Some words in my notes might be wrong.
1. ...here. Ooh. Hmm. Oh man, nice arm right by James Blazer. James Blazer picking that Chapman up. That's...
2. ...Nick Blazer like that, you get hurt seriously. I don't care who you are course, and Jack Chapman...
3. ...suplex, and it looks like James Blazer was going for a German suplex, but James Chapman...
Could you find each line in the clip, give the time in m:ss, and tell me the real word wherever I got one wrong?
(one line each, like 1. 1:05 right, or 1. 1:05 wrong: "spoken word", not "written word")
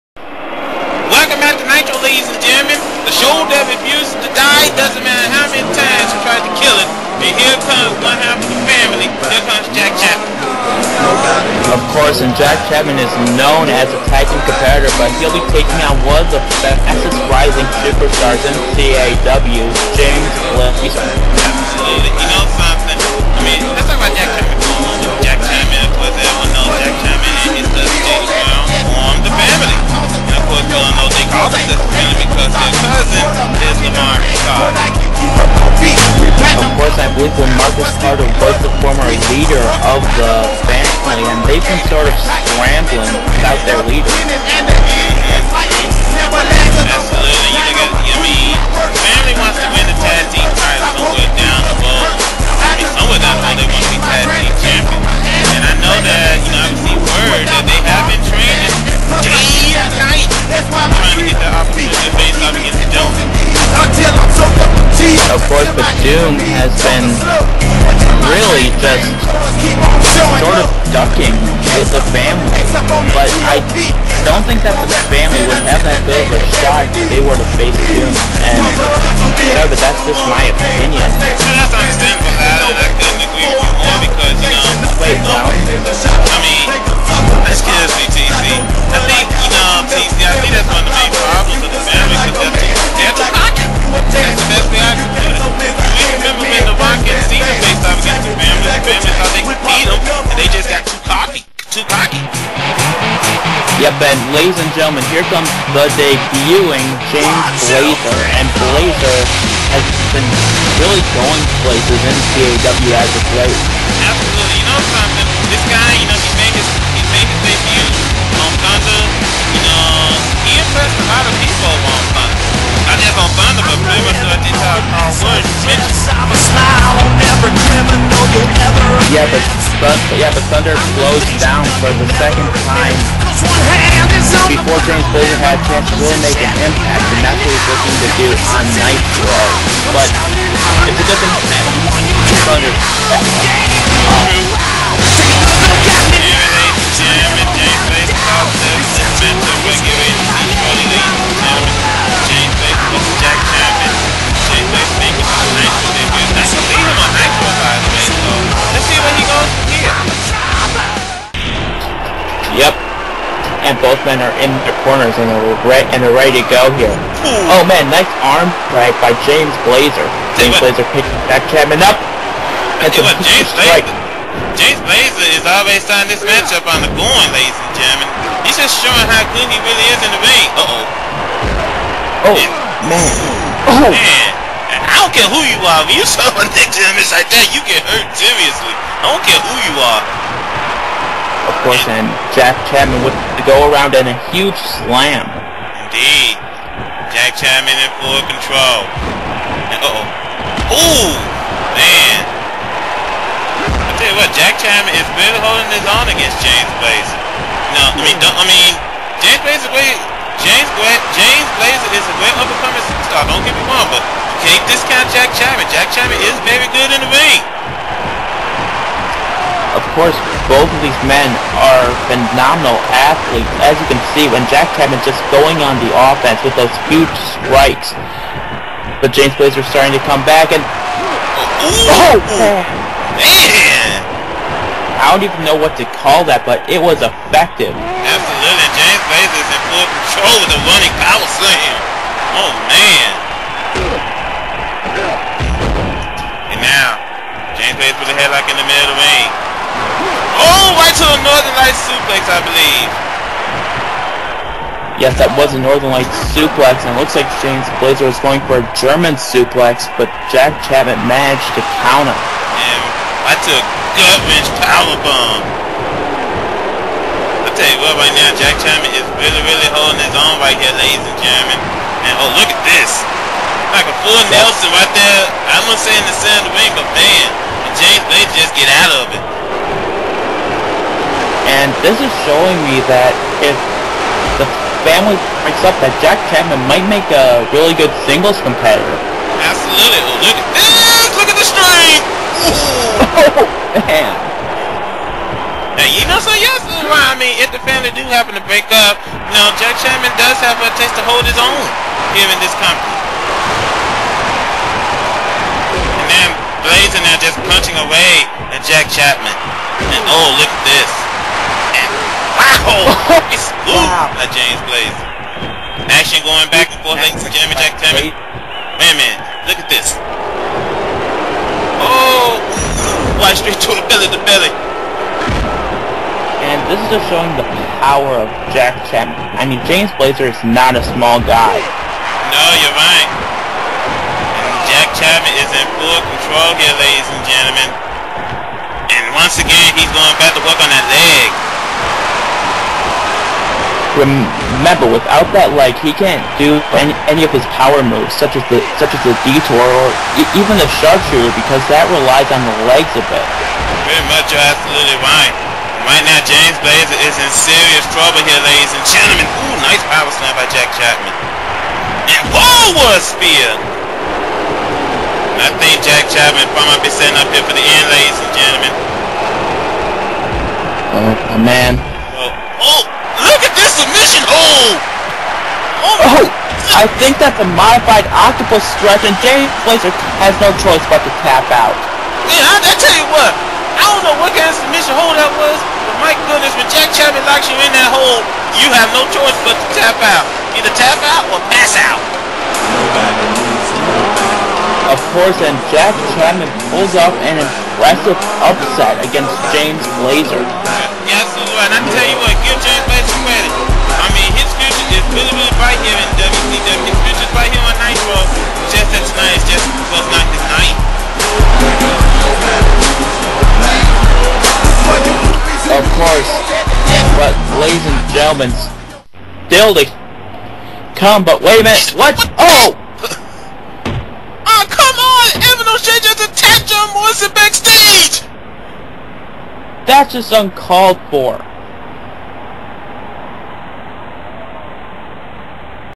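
1. 2:46 right
2. 3:06 wrong: "James", not "Blazer"
3. 4:16 wrong: "Jack", not "James".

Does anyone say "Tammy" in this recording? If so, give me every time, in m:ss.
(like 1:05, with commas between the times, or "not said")
5:17.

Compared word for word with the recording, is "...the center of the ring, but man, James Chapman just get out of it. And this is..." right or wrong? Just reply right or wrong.
wrong.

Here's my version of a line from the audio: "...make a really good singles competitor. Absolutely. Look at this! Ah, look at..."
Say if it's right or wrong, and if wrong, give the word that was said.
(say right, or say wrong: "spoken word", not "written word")
right.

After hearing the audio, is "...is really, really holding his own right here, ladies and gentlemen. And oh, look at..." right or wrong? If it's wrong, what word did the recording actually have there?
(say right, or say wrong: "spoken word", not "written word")
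right.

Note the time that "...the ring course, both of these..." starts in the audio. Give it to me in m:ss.
3:36.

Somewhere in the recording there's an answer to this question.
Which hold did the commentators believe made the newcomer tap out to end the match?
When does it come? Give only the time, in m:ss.
6:17.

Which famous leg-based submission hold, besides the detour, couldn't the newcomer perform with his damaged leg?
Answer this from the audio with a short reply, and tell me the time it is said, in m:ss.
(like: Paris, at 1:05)
sharpshooter, at 5:50.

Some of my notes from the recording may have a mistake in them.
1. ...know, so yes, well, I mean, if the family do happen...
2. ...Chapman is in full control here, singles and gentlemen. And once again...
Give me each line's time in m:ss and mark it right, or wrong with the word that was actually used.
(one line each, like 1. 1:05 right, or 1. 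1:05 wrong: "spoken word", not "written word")
1. 4:56 right
2. 5:34 wrong: "ladies", not "singles".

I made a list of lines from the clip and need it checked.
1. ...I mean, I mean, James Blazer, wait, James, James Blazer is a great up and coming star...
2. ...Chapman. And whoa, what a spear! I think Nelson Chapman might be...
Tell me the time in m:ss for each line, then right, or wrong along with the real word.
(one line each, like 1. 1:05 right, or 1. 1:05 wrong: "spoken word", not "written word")
1. 3:27 right
2. 6:00 wrong: "Jack", not "Nelson".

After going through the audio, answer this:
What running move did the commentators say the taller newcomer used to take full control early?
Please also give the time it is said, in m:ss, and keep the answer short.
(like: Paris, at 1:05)
running power slam, at 4:00.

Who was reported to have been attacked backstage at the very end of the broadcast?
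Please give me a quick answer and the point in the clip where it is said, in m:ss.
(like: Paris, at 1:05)
John Morrison, at 7:06.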